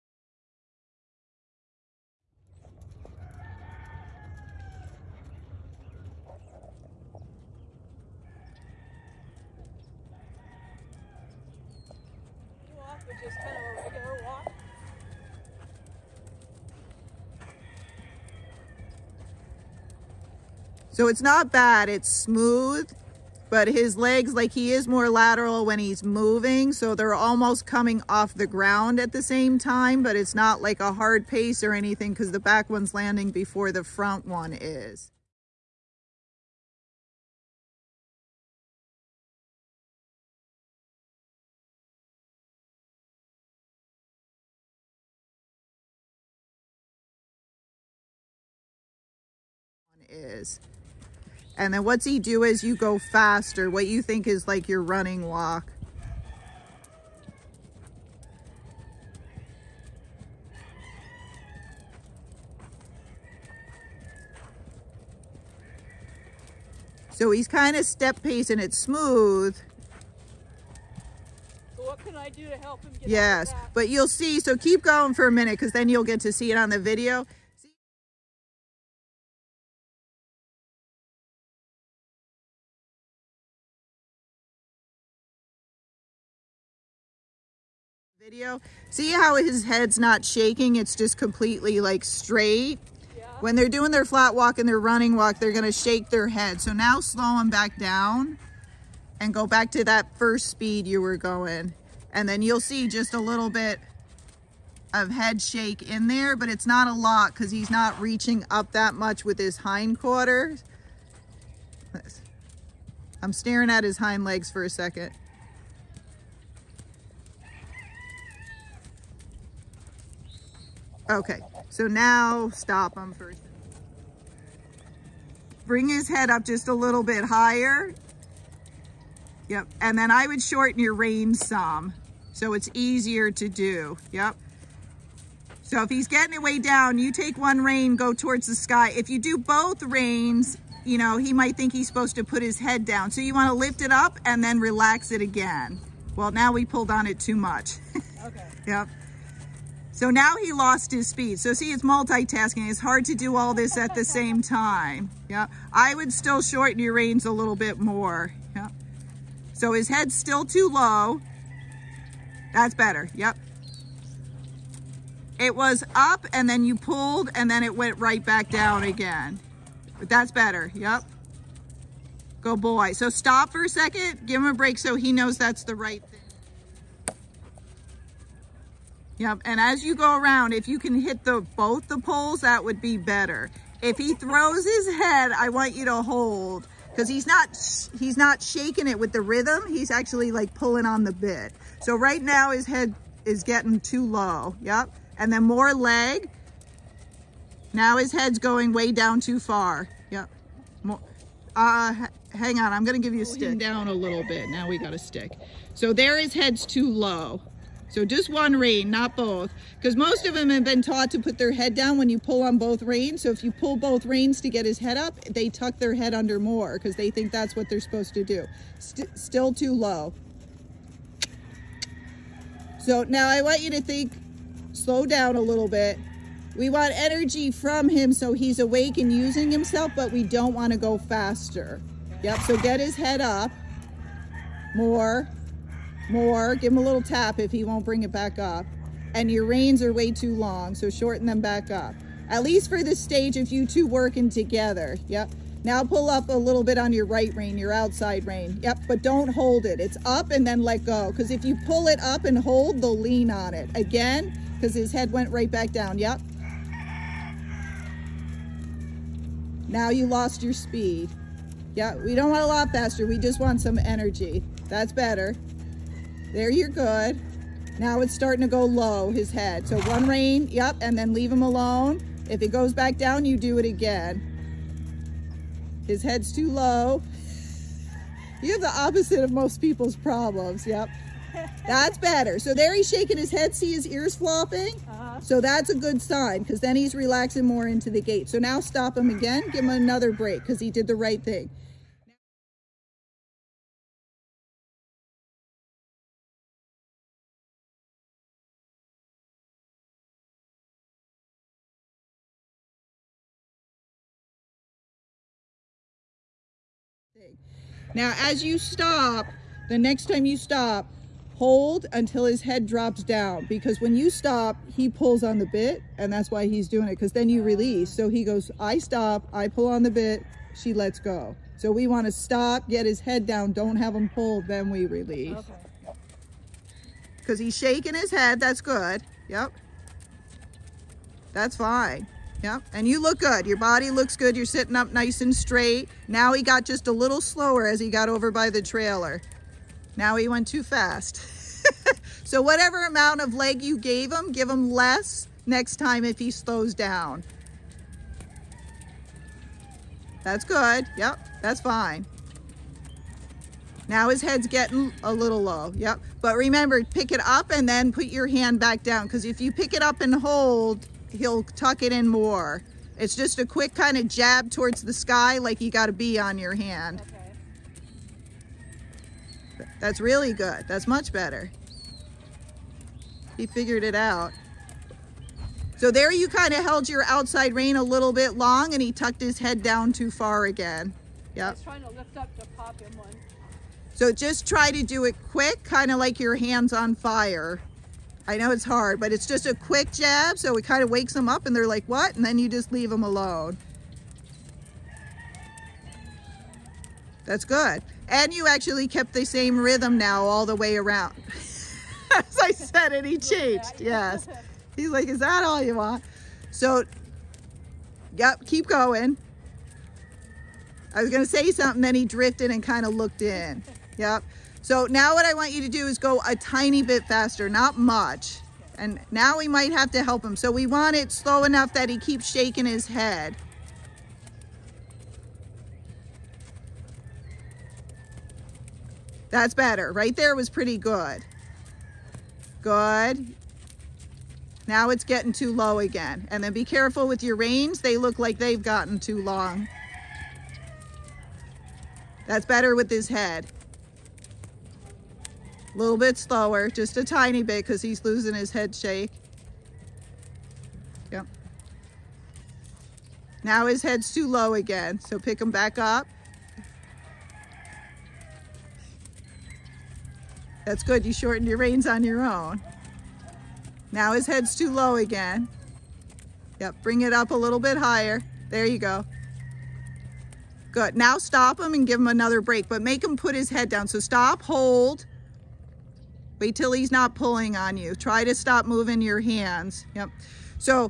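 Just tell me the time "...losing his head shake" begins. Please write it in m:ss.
7:28.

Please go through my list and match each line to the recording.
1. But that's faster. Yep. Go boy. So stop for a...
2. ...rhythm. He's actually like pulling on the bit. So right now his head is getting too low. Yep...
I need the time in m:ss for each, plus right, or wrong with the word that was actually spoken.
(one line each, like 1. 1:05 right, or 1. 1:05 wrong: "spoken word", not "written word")
1. 2:49 wrong: "better", not "faster"
2. 3:09 right.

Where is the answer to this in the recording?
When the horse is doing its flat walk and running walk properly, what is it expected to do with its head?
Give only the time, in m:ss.
1:35.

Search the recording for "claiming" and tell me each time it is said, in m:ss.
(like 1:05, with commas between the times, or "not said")
not said.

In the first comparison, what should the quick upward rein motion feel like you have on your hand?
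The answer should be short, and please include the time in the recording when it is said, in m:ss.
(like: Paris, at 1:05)
a bee, at 6:05.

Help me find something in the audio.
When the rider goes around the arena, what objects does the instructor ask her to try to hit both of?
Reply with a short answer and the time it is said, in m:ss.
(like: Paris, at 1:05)
the poles, at 3:01.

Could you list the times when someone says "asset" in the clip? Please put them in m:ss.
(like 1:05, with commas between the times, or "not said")
not said.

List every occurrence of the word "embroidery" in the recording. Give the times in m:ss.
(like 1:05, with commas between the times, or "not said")
not said.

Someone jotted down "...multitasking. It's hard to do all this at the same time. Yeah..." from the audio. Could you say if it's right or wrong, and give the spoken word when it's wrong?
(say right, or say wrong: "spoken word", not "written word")
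right.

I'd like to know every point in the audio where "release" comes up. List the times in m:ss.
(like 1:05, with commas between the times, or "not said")
5:17, 5:24.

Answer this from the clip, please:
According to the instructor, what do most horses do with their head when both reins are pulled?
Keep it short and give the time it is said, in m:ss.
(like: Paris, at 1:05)
put their head down, at 3:31.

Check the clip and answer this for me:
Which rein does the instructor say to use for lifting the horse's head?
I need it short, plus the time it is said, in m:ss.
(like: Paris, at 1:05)
right rein, at 4:07.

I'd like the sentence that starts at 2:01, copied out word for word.
Okay, so now stop him first.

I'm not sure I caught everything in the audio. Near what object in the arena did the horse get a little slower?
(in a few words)
the trailer.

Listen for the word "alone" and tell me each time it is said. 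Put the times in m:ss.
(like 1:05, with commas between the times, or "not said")
4:31, 6:33.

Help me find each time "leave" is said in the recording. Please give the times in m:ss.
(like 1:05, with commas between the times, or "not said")
4:31, 6:32.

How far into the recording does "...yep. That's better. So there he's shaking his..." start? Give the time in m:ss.
4:40.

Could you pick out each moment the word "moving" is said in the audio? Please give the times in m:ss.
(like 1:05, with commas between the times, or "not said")
0:26, 7:58.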